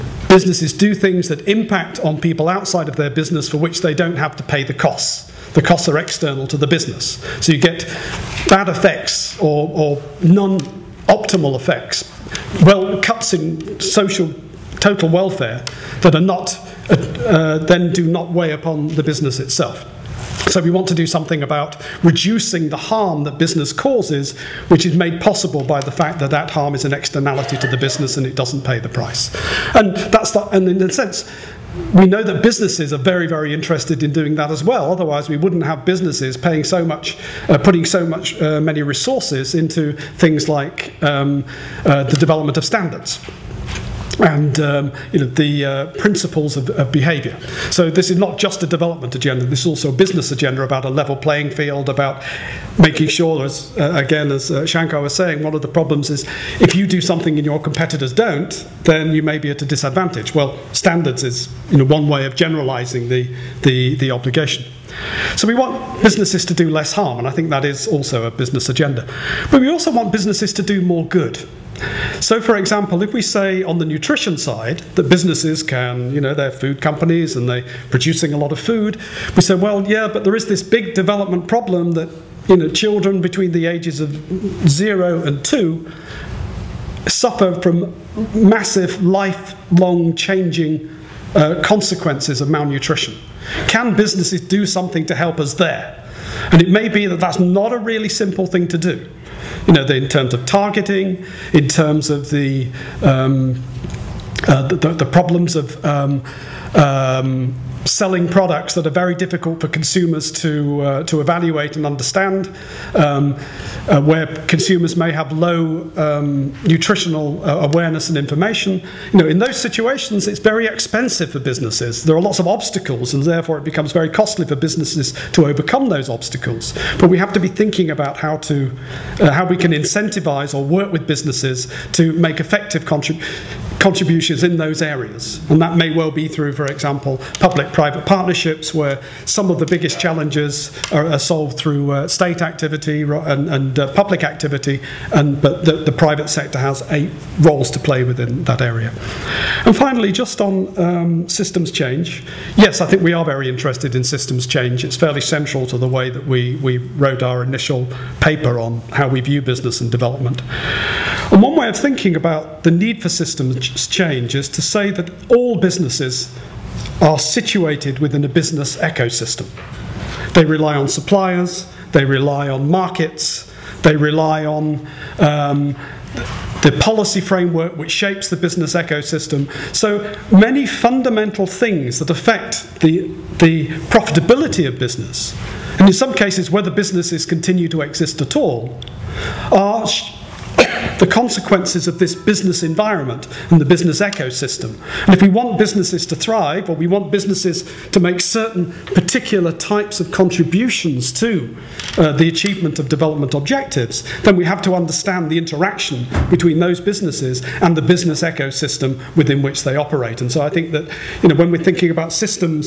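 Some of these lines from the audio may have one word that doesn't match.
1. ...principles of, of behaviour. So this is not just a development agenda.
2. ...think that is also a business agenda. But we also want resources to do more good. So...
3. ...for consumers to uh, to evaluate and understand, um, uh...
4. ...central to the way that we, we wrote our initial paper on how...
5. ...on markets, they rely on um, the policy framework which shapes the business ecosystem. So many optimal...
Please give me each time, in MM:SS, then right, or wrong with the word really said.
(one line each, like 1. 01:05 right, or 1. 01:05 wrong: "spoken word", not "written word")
1. 00:45 right
2. 01:07 wrong: "businesses", not "resources"
3. 01:49 right
4. 02:35 right
5. 02:52 wrong: "fundamental", not "optimal".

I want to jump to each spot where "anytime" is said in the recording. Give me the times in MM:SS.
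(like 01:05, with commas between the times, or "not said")
not said.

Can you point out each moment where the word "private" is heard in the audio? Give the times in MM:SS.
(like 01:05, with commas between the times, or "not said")
02:17, 02:25.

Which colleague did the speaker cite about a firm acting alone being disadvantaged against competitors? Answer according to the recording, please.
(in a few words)
Shankar.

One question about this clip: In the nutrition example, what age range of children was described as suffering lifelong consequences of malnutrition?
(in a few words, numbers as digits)
0 to 2.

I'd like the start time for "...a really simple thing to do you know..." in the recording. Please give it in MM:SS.
01:37.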